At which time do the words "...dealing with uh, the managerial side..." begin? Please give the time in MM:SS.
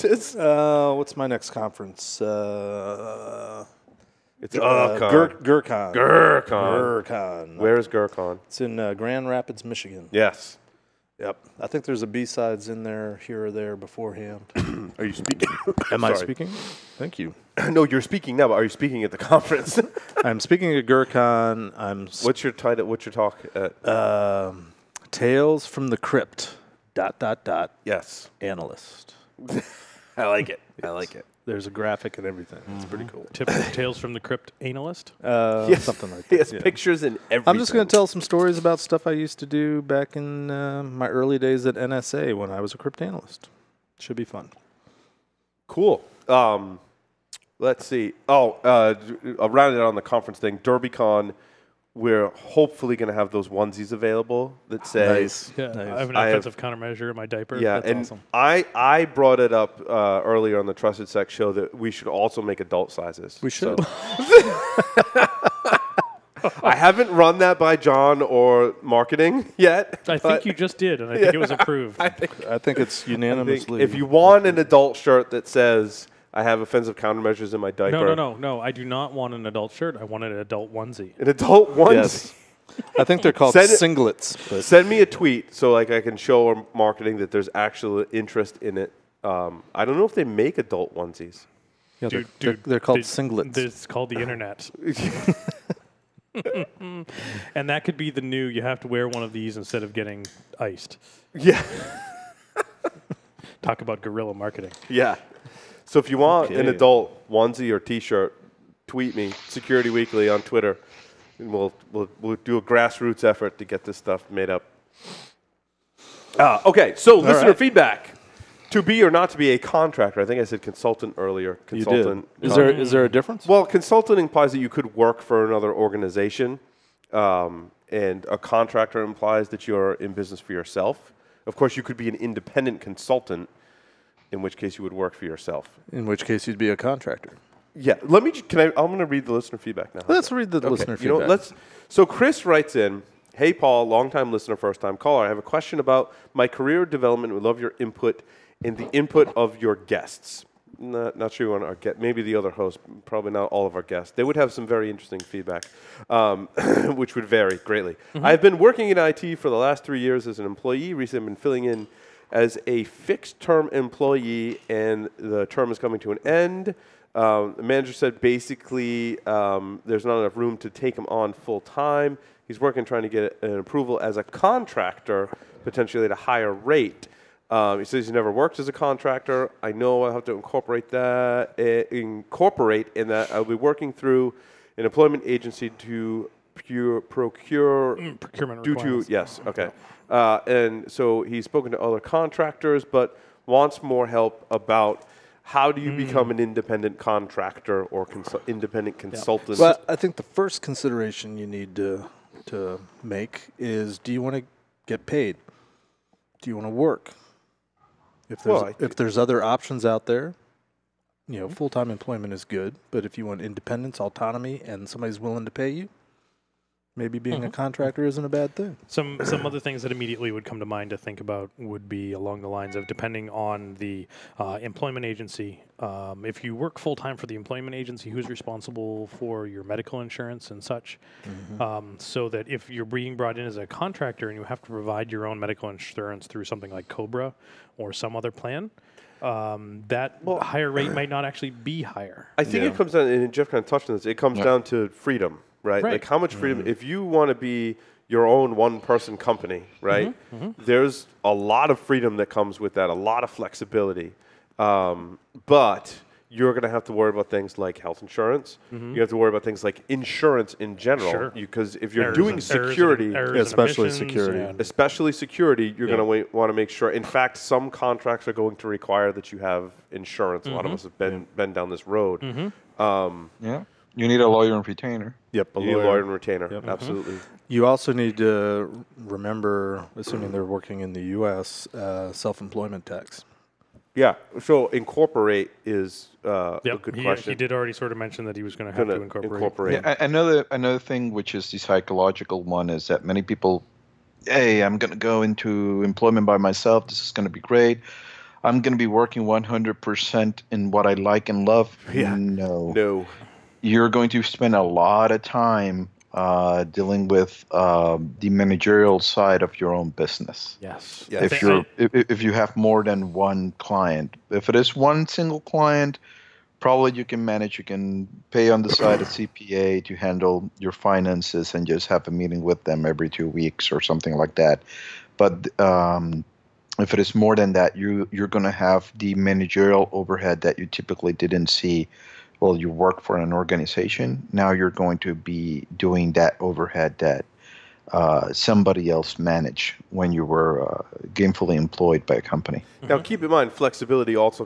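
05:06.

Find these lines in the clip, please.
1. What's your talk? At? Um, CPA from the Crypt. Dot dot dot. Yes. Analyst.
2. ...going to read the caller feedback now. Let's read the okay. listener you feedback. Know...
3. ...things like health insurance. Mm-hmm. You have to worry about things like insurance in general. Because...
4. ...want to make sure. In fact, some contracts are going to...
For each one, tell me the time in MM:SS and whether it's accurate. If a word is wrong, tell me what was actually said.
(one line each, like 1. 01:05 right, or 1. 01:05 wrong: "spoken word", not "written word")
1. 00:22 wrong: "Tales", not "CPA"
2. 02:18 wrong: "listener", not "caller"
3. 04:17 right
4. 04:26 right.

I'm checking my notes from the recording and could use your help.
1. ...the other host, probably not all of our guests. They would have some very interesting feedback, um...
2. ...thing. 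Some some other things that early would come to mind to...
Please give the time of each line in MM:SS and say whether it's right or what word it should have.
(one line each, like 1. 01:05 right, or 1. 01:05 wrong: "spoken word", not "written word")
1. 02:32 right
2. 03:38 wrong: "immediately", not "early".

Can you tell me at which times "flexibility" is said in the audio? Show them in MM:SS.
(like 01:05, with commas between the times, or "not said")
04:13, 05:43.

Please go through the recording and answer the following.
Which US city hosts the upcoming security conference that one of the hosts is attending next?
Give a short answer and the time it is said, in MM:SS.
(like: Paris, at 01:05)
Grand Rapids, Michigan, at 00:08.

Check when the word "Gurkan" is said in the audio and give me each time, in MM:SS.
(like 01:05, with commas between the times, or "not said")
00:20.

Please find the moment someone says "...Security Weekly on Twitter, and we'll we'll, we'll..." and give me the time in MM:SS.
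01:49.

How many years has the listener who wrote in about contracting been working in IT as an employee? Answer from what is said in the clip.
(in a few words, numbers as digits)
3.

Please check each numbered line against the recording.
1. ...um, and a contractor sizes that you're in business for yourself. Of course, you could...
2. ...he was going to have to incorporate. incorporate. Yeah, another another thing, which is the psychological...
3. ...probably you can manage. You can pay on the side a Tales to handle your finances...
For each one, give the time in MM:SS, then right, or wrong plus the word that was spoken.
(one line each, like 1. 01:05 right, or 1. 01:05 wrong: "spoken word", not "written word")
1. 02:07 wrong: "implies", not "sizes"
2. 04:48 right
3. 05:16 wrong: "CPA", not "Tales".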